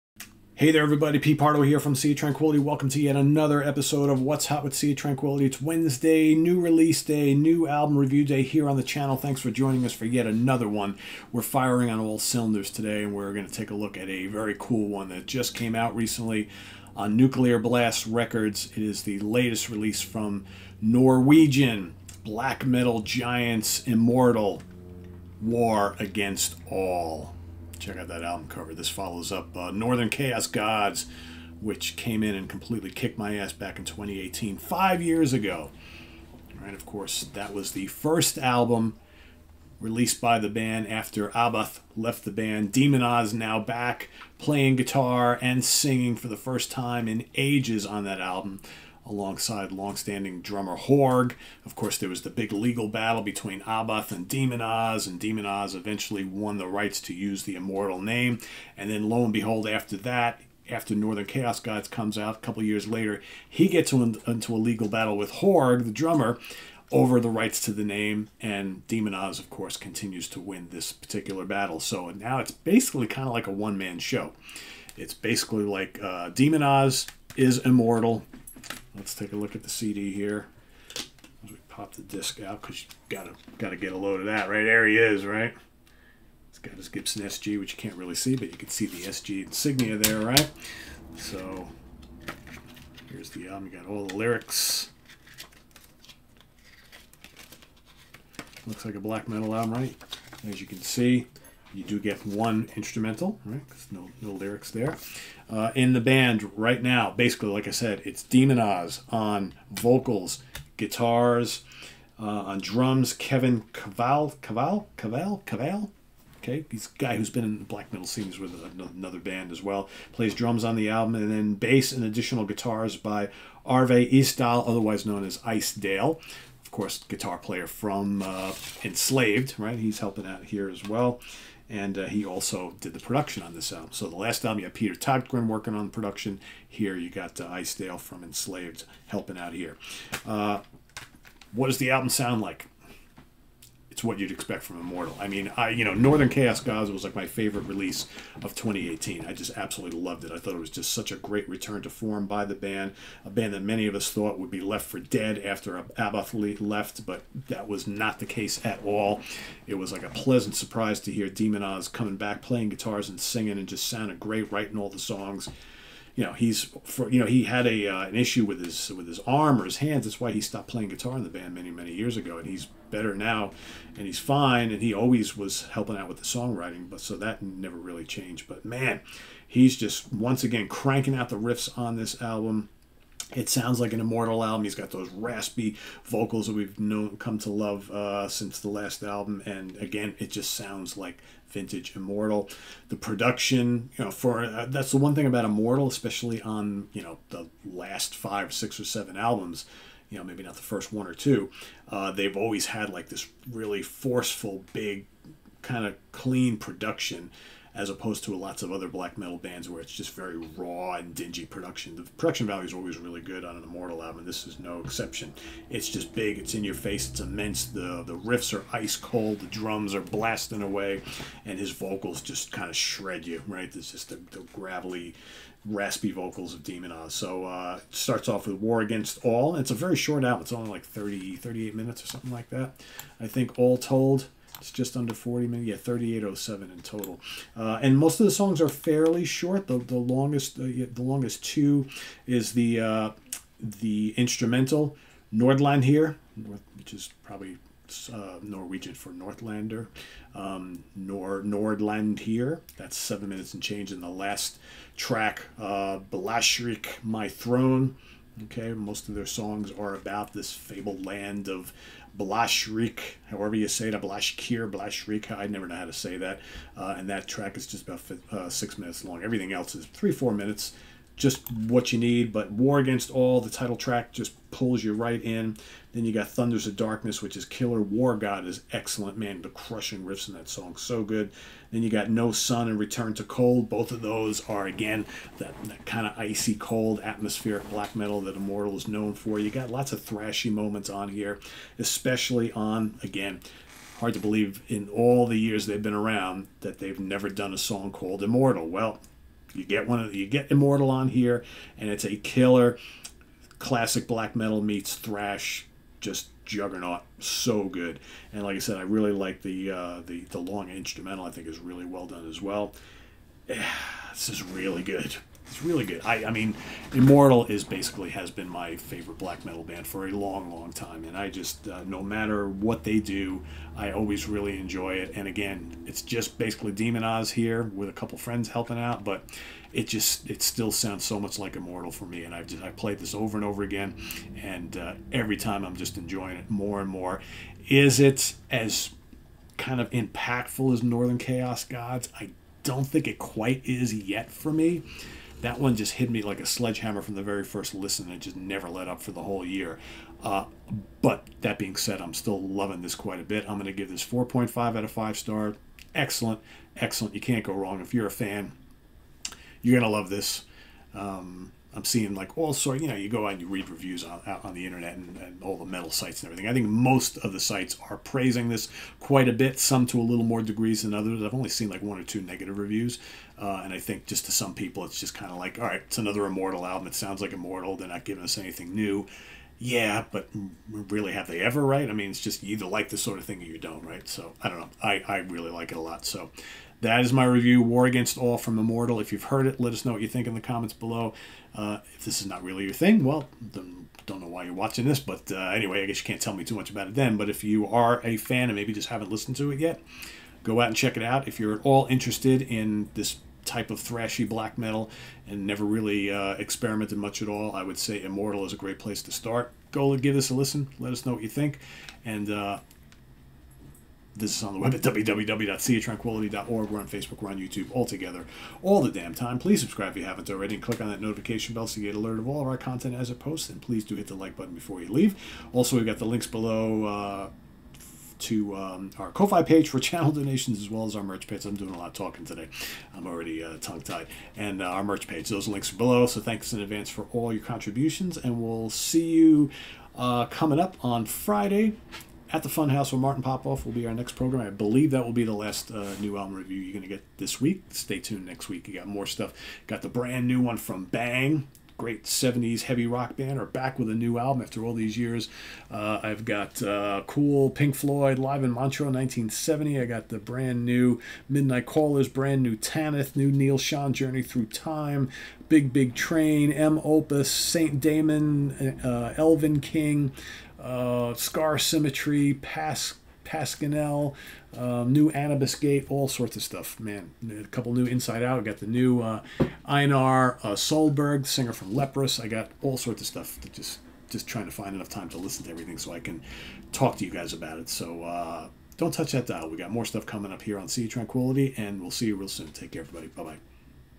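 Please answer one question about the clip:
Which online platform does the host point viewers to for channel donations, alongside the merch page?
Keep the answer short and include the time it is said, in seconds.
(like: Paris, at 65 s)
Ko-Fi, at 429 s.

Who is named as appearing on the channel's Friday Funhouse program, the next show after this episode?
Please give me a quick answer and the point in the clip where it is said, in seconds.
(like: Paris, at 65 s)
Martin Popoff, at 443 s.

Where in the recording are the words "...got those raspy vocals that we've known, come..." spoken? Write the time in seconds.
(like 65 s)
184 s.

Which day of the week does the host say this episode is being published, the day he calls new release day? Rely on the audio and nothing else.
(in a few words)
Wednesday.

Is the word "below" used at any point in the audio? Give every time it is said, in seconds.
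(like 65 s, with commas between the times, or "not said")
390 s, 426 s, 435 s.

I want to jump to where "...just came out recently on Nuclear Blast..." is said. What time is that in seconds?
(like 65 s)
15 s.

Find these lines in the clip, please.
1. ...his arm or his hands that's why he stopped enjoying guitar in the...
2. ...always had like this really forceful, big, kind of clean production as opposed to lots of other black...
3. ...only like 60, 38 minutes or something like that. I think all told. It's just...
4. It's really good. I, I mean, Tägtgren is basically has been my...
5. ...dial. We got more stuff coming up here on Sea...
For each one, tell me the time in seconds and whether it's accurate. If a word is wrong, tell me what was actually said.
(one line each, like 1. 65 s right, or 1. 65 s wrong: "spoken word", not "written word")
1. 169 s wrong: "playing", not "enjoying"
2. 202 s right
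3. 230 s wrong: "30", not "60"
4. 315 s wrong: "Immortal", not "Tägtgren"
5. 489 s right.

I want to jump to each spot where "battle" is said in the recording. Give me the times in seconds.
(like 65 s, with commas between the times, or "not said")
52 s, 64 s, 71 s.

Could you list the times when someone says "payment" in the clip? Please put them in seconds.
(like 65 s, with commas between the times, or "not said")
not said.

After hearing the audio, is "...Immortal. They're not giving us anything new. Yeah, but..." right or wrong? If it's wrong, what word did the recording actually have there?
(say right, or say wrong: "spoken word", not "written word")
right.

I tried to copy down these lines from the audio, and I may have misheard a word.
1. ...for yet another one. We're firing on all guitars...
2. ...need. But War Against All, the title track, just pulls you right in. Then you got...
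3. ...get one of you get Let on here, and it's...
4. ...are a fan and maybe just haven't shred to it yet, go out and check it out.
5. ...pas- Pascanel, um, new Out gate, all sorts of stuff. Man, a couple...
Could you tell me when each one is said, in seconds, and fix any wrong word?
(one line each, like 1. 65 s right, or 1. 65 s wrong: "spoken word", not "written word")
1. 9 s wrong: "cylinders", not "guitars"
2. 271 s right
3. 299 s wrong: "Immortal", not "Let"
4. 397 s wrong: "listened", not "shred"
5. 472 s wrong: "Anubis", not "Out".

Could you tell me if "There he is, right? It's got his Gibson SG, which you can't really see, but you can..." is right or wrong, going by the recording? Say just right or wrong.
right.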